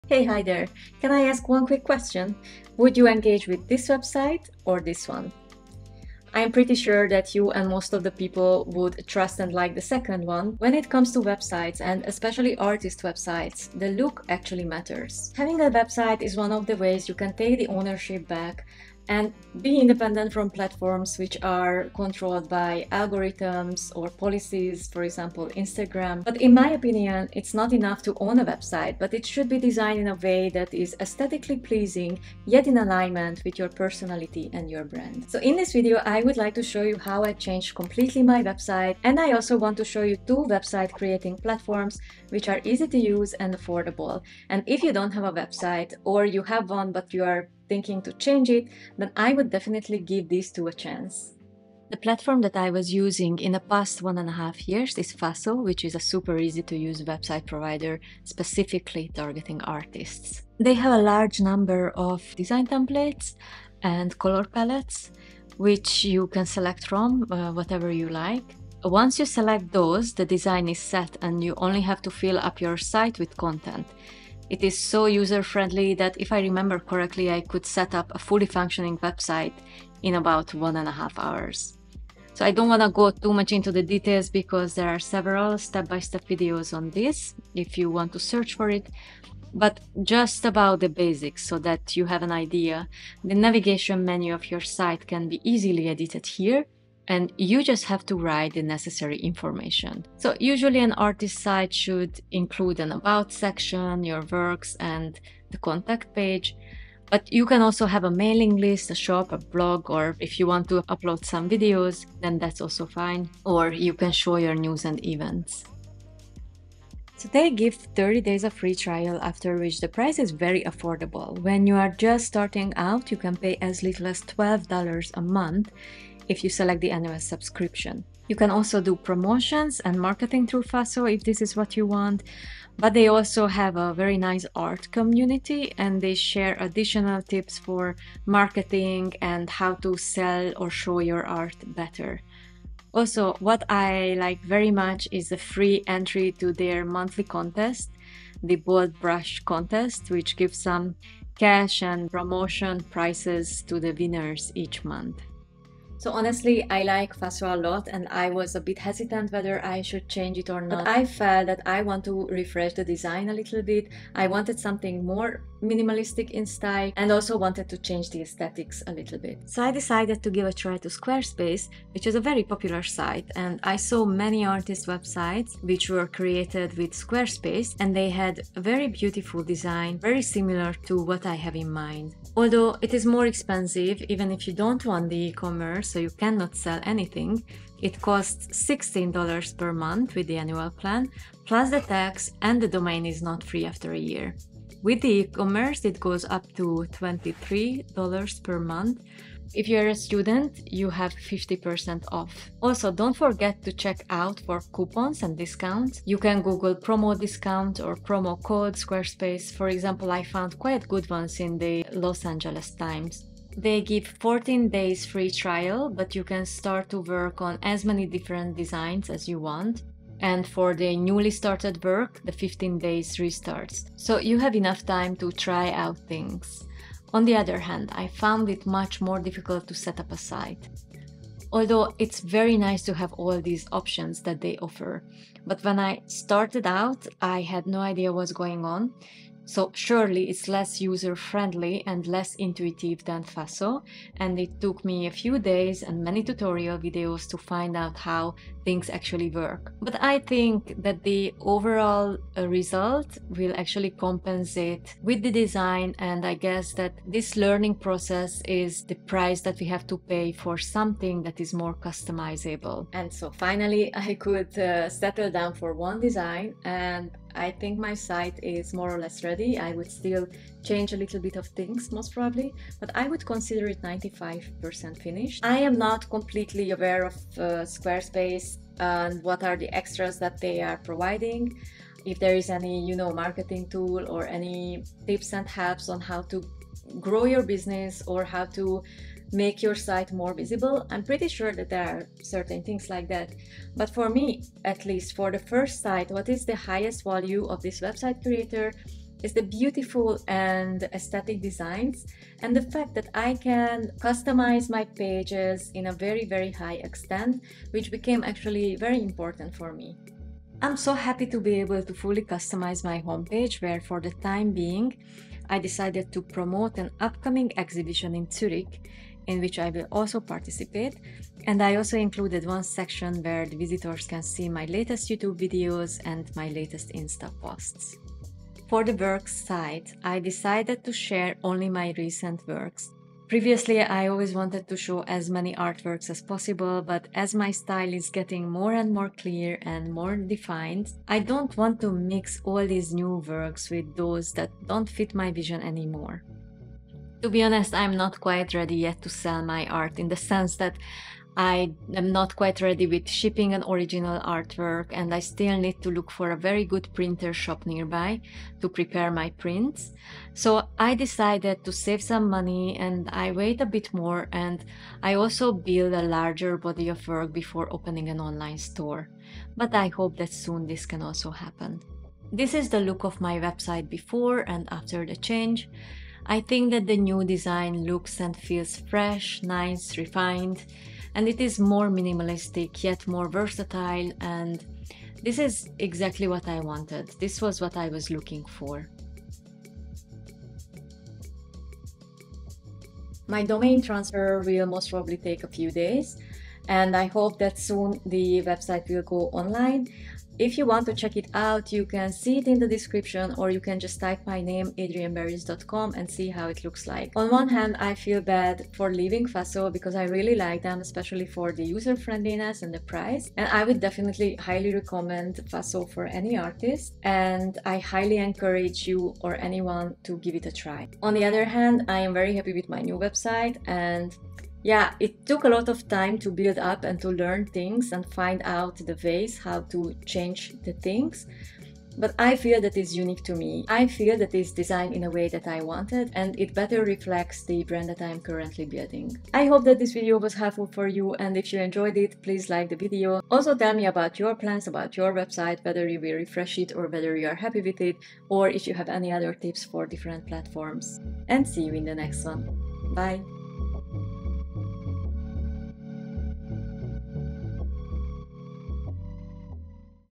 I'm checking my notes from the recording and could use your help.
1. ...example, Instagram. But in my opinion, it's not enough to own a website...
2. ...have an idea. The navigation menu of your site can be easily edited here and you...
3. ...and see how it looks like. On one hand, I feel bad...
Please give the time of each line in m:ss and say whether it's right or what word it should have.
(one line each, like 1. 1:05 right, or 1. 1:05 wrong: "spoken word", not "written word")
1. 0:25 right
2. 1:32 right
3. 6:45 right.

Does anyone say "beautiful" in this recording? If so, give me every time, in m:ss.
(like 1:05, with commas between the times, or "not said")
2:58, 4:59.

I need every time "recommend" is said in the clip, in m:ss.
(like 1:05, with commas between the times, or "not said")
6:54.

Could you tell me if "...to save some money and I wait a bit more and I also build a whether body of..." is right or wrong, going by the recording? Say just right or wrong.
wrong.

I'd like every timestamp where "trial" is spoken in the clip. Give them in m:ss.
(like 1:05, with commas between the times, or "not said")
1:58, 3:35.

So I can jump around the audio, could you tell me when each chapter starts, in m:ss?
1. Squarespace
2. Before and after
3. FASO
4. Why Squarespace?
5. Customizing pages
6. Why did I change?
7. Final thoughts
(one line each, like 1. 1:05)
1. 2:49
2. 6:12
3. 0:52
4. 4:23
5. 5:10
6. 2:36
7. 6:47.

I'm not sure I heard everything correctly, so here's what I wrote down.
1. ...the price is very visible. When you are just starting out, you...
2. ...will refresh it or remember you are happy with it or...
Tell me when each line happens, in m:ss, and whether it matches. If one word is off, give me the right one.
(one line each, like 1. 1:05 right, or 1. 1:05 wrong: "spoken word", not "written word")
1. 1:59 wrong: "affordable", not "visible"
2. 7:25 wrong: "whether", not "remember".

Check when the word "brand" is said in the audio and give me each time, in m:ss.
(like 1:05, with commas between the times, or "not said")
0:34, 7:17.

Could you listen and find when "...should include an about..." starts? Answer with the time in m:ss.
1:41.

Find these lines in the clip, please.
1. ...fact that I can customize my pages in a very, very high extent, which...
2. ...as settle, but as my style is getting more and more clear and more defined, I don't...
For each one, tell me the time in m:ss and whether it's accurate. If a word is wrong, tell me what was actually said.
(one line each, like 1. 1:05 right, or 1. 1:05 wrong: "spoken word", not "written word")
1. 5:02 right
2. 5:36 wrong: "possible", not "settle".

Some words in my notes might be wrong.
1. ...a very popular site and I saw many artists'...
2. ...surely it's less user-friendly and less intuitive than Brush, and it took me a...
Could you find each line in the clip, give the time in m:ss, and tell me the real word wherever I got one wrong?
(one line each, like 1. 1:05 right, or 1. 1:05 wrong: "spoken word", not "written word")
1. 2:52 right
2. 3:59 wrong: "Faso", not "Brush".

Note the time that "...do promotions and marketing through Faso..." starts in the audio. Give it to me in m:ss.
2:08.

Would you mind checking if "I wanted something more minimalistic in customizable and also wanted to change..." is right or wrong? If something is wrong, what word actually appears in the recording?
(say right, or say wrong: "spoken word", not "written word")
wrong: "style", not "customizable".